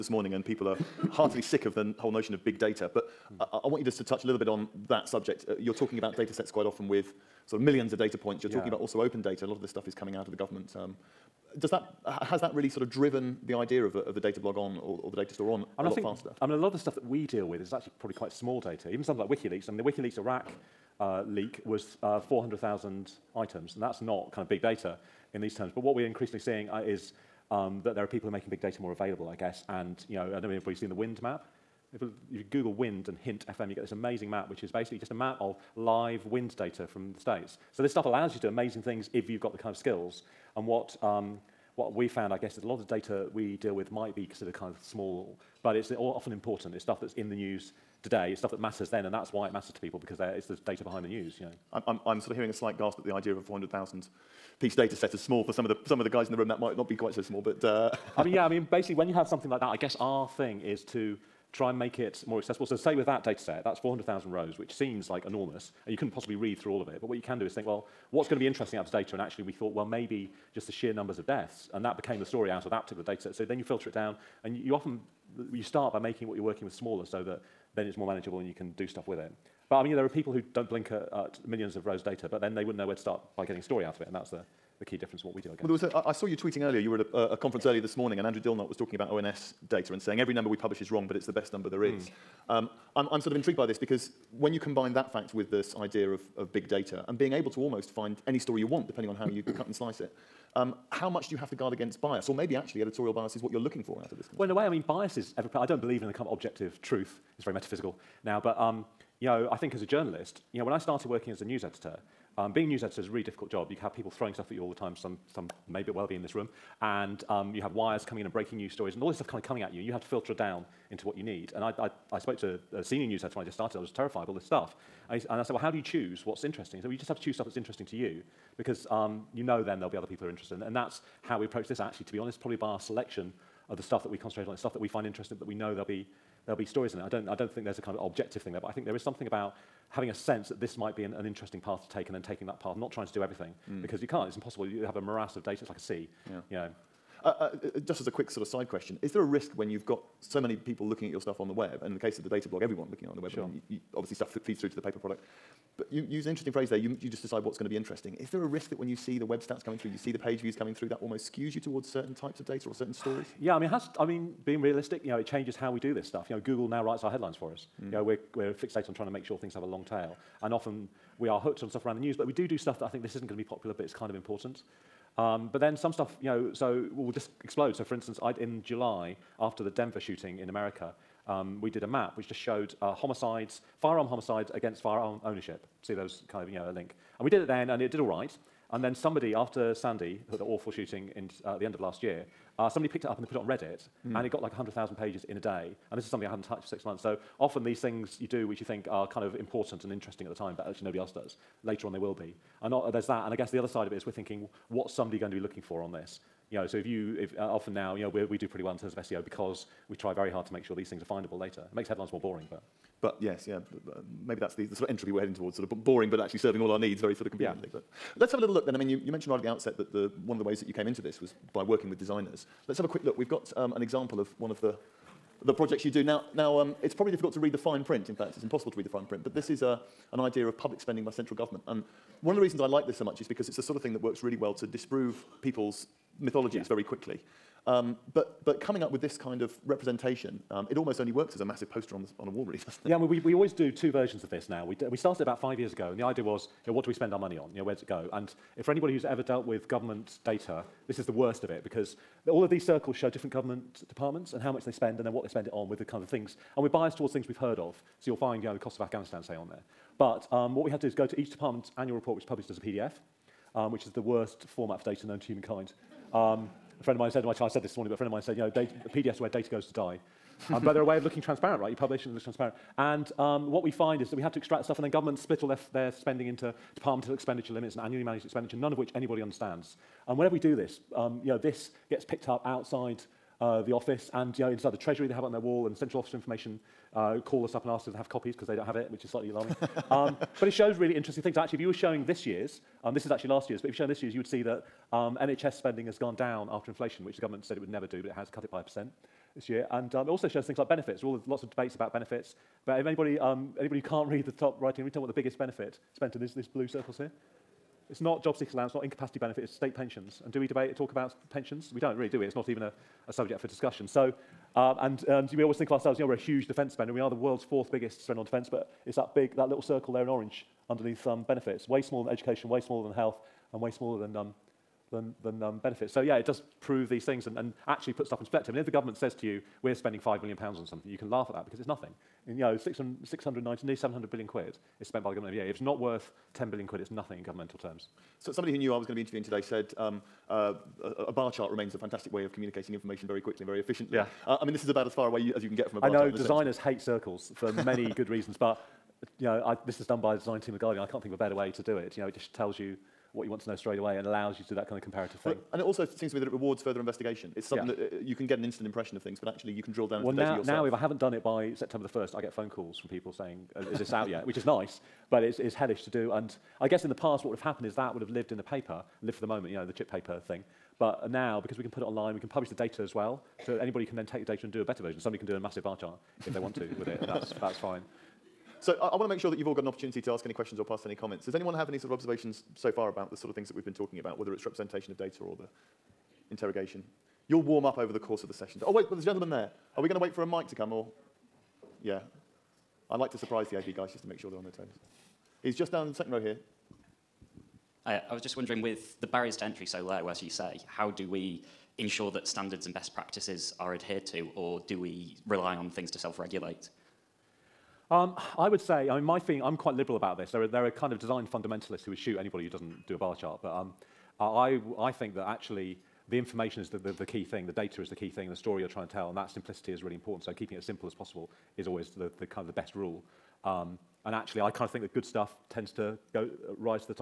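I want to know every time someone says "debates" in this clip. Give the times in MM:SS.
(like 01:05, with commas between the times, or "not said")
05:01, 05:10.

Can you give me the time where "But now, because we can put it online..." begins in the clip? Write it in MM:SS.
06:10.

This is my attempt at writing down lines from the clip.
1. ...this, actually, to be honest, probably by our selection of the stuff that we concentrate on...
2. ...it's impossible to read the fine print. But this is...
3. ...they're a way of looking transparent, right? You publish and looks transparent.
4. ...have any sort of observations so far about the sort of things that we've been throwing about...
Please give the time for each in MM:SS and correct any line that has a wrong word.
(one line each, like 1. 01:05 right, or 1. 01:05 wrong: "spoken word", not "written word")
1. 02:11 right
2. 03:48 right
3. 04:30 right
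4. 06:21 wrong: "talking", not "throwing".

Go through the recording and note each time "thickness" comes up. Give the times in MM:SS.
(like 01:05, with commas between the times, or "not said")
not said.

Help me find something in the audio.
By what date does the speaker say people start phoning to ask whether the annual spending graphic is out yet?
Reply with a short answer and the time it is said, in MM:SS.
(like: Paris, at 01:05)
September 1st, at 06:01.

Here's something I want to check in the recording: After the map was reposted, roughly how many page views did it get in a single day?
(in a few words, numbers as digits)
100,000.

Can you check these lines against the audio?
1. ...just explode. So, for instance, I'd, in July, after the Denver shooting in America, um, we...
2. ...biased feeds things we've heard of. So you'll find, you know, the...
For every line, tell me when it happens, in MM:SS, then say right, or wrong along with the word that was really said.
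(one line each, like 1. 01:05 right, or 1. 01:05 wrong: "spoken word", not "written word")
1. 02:57 right
2. 04:16 wrong: "towards", not "feeds".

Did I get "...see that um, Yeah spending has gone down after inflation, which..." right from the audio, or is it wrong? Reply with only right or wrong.
wrong.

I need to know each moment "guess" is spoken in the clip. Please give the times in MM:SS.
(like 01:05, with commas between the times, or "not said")
00:29, 00:42, 00:59, 01:25, 03:23, 06:06.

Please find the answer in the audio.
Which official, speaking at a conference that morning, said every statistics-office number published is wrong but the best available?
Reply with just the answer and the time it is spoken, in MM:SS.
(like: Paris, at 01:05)
Andrew Dilnot, at 01:28.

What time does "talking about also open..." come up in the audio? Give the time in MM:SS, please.
00:08.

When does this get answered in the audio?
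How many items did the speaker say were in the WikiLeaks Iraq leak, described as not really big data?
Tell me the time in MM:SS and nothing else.
00:22.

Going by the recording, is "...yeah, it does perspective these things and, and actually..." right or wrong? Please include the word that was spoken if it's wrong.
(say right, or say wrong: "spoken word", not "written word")
wrong: "prove", not "perspective".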